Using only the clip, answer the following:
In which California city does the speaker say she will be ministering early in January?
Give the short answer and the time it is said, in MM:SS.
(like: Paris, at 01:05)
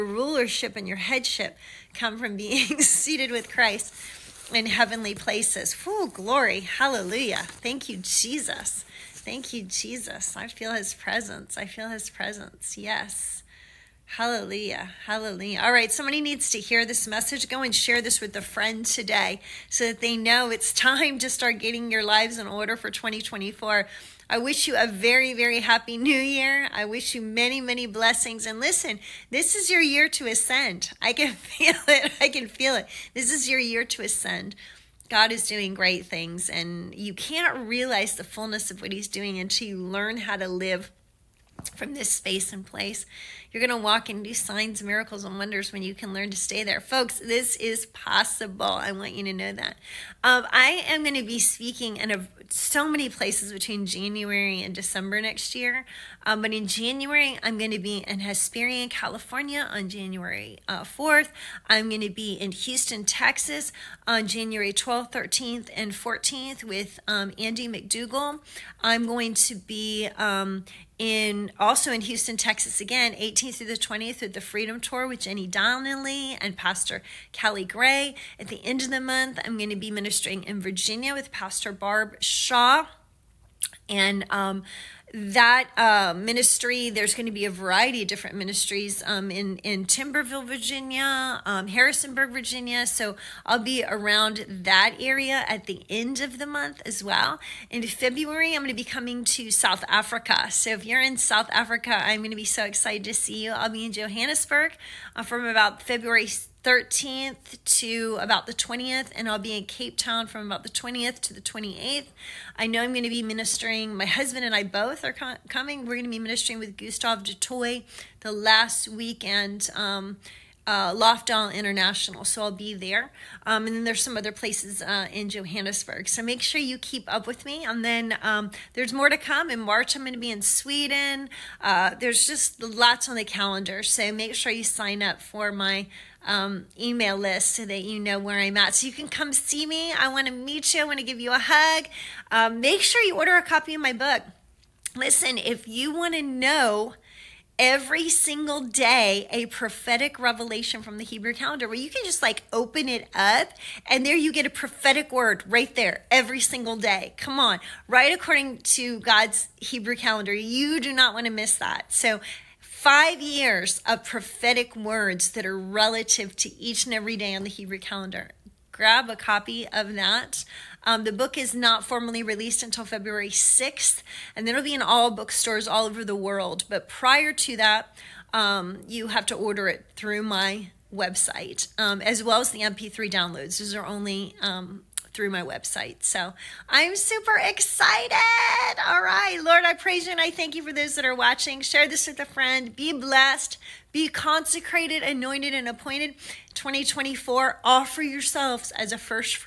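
Hesperia, at 00:58.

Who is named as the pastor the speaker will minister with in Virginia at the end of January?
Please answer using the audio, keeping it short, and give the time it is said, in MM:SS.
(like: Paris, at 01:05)
Barb Shaw, at 01:21.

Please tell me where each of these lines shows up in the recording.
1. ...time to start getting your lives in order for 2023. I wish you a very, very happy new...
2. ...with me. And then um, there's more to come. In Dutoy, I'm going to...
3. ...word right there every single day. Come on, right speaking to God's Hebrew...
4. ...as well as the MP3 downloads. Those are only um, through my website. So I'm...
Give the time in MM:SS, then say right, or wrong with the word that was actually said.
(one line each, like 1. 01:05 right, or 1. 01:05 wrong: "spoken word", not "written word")
1. 00:20 wrong: "2024", not "2023"
2. 02:07 wrong: "March", not "Dutoy"
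3. 02:35 wrong: "according", not "speaking"
4. 03:02 right.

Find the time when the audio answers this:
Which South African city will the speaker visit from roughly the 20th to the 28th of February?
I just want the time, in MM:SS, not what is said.
01:49.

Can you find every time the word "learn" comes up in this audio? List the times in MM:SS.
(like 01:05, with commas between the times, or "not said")
00:39, 00:46.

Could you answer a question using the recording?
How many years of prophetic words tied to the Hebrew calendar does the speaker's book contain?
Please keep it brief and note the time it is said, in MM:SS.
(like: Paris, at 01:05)
5, at 02:42.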